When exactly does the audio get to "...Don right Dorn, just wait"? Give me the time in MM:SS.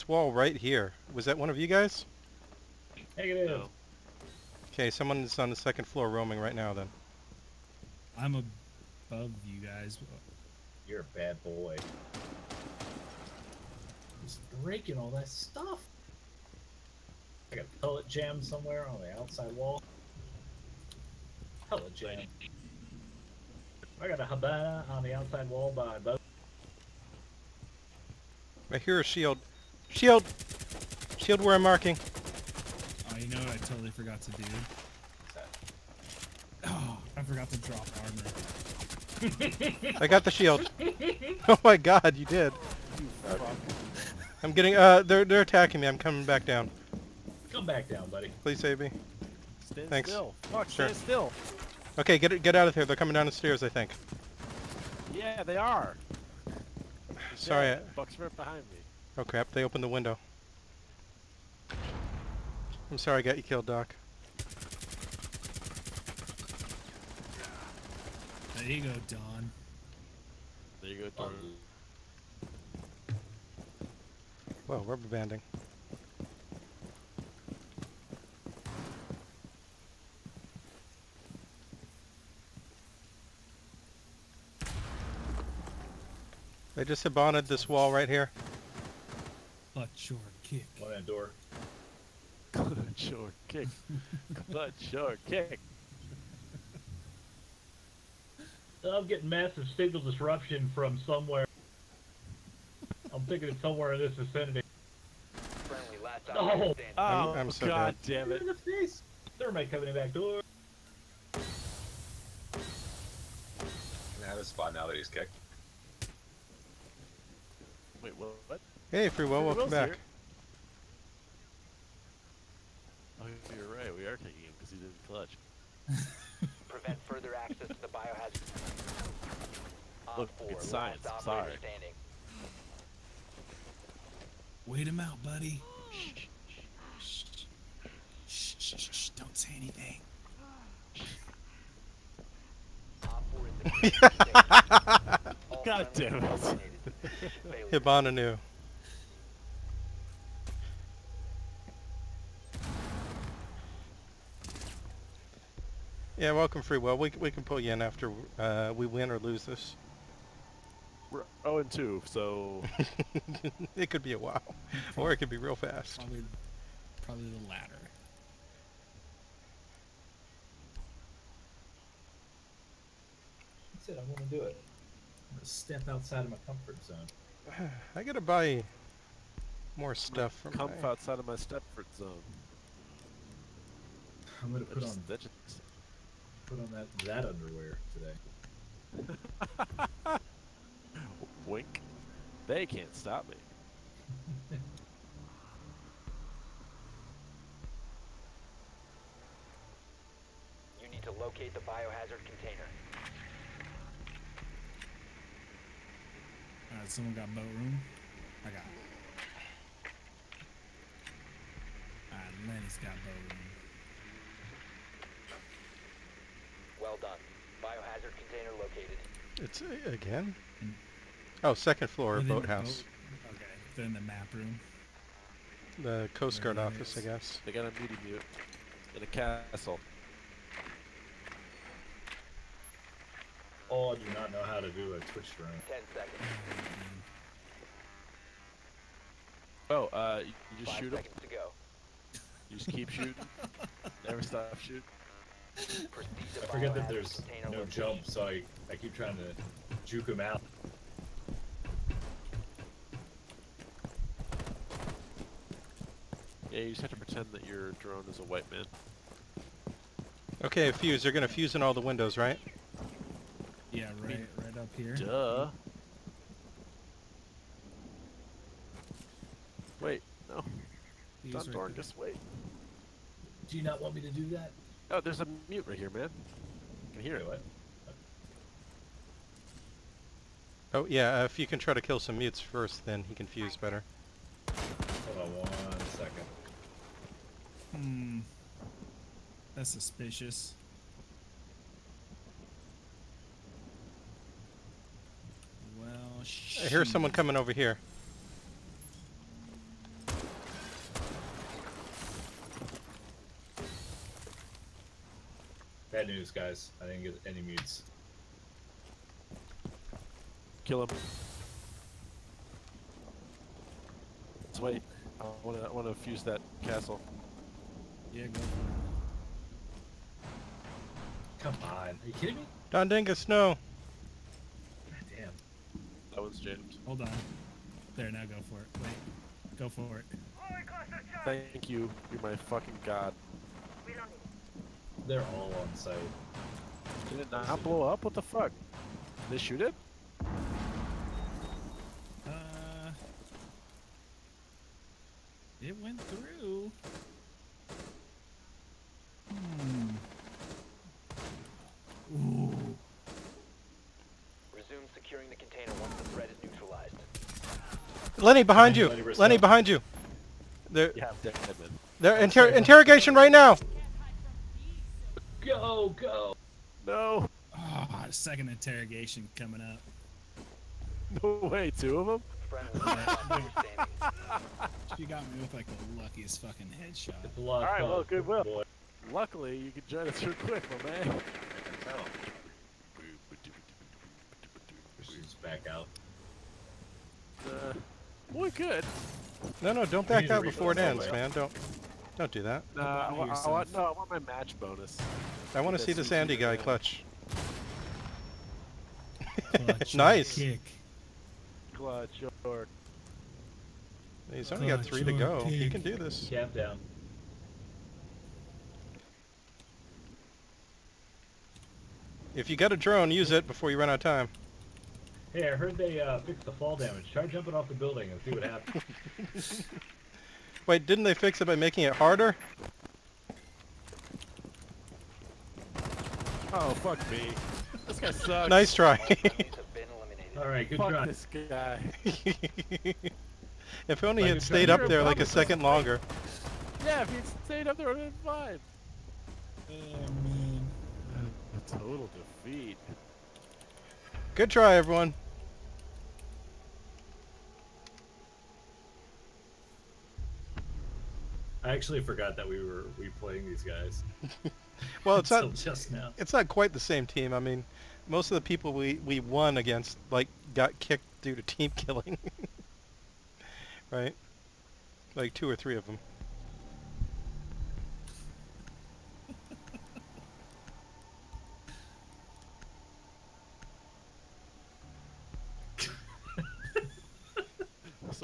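04:31.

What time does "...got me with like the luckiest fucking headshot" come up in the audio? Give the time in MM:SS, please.
06:15.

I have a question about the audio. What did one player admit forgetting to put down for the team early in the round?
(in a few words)
Armor.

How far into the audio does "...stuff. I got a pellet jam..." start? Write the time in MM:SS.
00:15.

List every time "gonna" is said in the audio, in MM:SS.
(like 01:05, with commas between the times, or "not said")
02:54, 03:04, 04:21.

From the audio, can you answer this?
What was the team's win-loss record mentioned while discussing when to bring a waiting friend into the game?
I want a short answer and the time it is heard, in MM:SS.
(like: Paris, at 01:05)
0 and 2, at 02:41.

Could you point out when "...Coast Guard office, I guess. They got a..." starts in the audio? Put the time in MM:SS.
03:46.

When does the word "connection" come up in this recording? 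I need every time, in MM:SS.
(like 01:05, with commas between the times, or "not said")
not said.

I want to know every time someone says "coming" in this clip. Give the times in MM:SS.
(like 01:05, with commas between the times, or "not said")
00:45, 00:52, 04:57, 06:09.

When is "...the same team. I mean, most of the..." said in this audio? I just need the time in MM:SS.
07:36.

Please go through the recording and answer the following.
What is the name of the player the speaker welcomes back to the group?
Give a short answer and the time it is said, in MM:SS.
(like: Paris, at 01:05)
Free Will, at 01:58.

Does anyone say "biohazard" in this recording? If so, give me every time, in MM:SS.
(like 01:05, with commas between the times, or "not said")
02:07, 03:21, 03:37.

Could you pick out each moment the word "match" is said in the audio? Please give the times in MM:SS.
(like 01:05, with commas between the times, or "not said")
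06:34.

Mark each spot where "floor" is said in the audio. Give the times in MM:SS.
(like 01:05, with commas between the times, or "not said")
00:05, 03:41.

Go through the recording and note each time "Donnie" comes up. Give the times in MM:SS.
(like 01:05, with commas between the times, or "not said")
not said.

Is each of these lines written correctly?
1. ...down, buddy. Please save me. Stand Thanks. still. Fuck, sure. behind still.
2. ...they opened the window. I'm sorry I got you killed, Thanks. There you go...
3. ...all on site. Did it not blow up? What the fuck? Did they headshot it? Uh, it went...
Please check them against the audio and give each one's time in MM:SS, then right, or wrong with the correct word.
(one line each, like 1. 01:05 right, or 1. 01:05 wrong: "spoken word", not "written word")
1. 00:47 wrong: "stand", not "behind"
2. 00:59 wrong: "Doc", not "Thanks"
3. 05:35 wrong: "shoot", not "headshot".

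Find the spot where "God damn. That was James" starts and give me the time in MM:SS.
05:24.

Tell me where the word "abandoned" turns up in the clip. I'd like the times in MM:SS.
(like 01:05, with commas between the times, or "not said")
01:27.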